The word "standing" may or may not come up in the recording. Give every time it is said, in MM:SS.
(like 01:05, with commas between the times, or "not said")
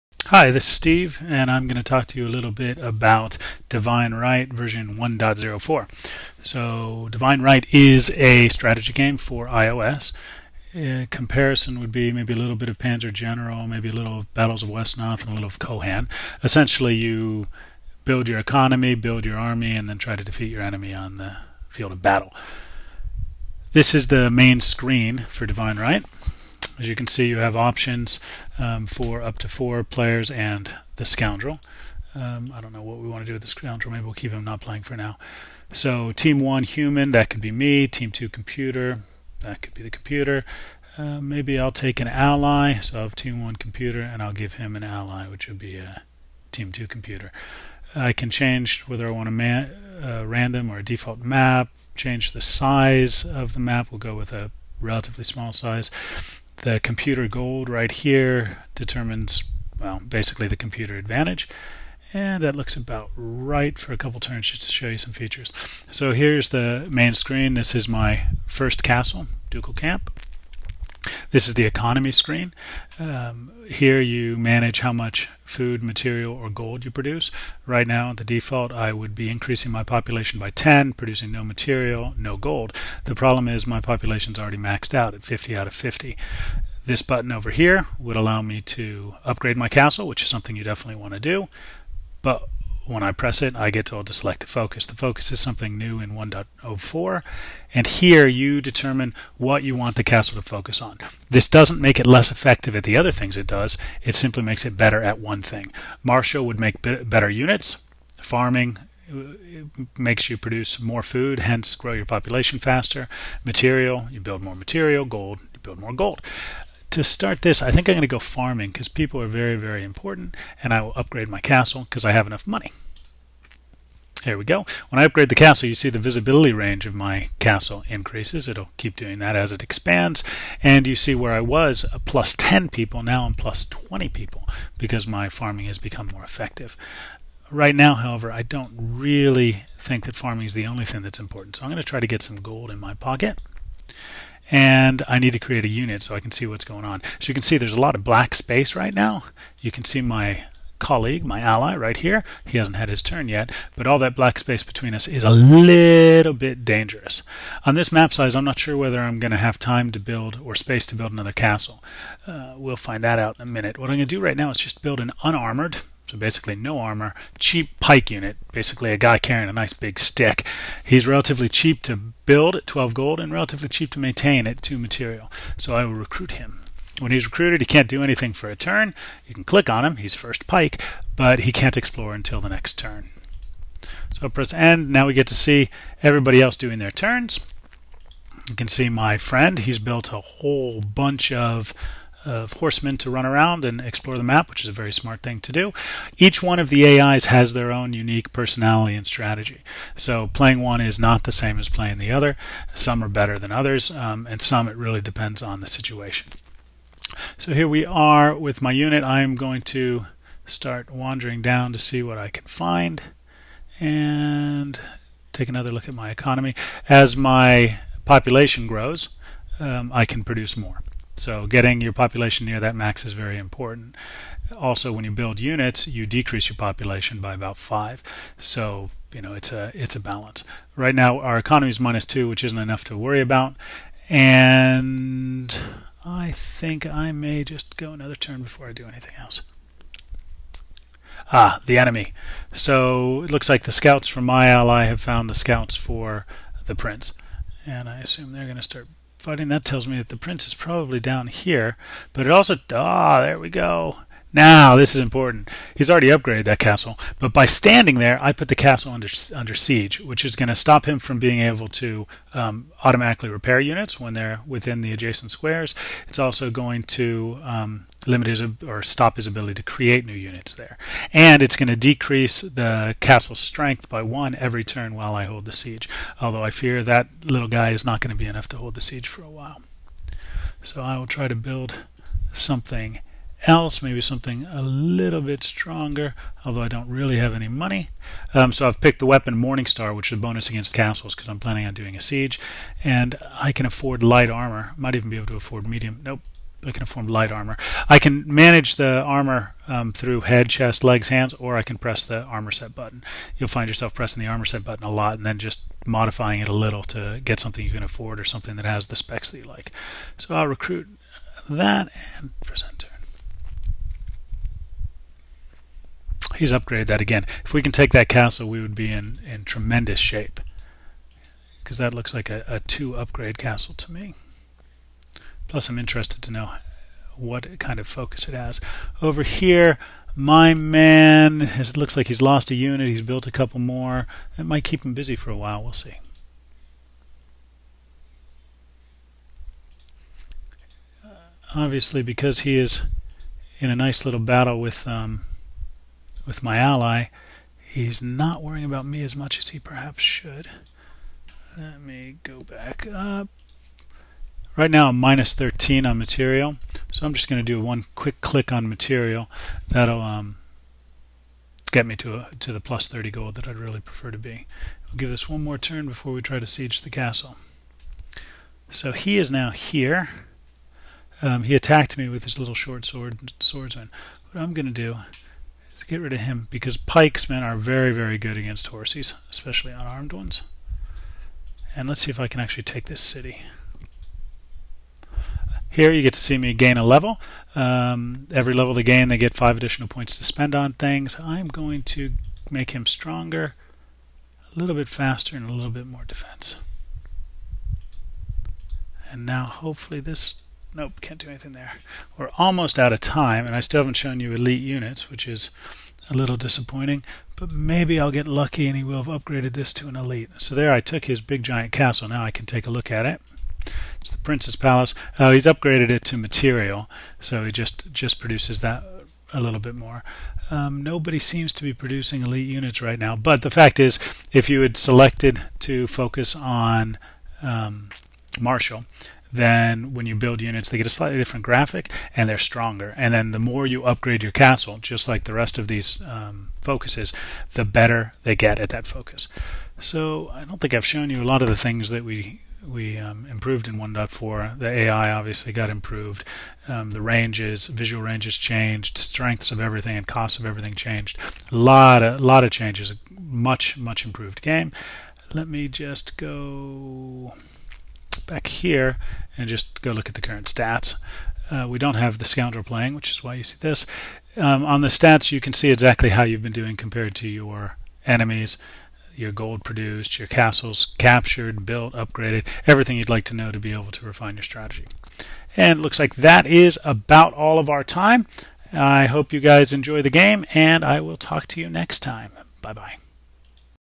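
04:17.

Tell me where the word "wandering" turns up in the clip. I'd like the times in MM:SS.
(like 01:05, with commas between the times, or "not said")
03:30.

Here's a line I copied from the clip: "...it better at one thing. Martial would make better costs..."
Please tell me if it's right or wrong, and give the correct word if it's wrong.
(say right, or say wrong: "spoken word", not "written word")
wrong: "units", not "costs".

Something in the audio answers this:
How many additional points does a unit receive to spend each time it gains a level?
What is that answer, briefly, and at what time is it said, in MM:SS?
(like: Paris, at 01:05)
5, at 06:29.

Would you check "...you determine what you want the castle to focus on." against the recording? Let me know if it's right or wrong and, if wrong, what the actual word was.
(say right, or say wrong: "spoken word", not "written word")
right.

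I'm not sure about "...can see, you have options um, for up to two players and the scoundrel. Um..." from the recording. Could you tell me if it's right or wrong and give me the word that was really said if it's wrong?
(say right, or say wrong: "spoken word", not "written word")
wrong: "four", not "two".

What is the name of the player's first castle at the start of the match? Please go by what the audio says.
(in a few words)
Ducal Camp.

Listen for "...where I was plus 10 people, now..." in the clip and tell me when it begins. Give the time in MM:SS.
02:11.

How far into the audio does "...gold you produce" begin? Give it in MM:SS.
01:16.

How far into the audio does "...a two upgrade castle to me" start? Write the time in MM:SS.
05:22.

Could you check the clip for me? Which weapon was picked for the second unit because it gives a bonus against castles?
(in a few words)
Morningstar.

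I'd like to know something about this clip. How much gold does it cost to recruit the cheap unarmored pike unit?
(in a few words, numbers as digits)
12 gold.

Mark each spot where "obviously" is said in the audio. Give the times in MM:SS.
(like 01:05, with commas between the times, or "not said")
05:41, 07:25.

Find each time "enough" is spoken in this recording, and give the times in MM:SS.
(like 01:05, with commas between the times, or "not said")
02:02, 03:52, 04:38.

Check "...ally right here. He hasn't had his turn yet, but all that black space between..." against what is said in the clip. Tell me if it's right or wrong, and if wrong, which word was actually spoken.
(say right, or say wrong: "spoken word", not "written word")
right.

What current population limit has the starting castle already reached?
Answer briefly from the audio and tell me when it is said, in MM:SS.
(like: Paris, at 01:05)
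50, at 01:25.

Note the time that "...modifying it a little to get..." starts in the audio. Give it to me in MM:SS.
05:05.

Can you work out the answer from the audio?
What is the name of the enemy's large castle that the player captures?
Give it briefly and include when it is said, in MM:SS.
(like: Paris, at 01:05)
Prince's Palace, at 06:54.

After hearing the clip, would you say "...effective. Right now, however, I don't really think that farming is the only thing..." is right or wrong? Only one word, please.
right.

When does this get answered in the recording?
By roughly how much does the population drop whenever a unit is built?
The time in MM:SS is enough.
03:47.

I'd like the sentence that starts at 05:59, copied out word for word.
That'll um, get me to, a, to the plus 30 gold that I'd really prefer to be.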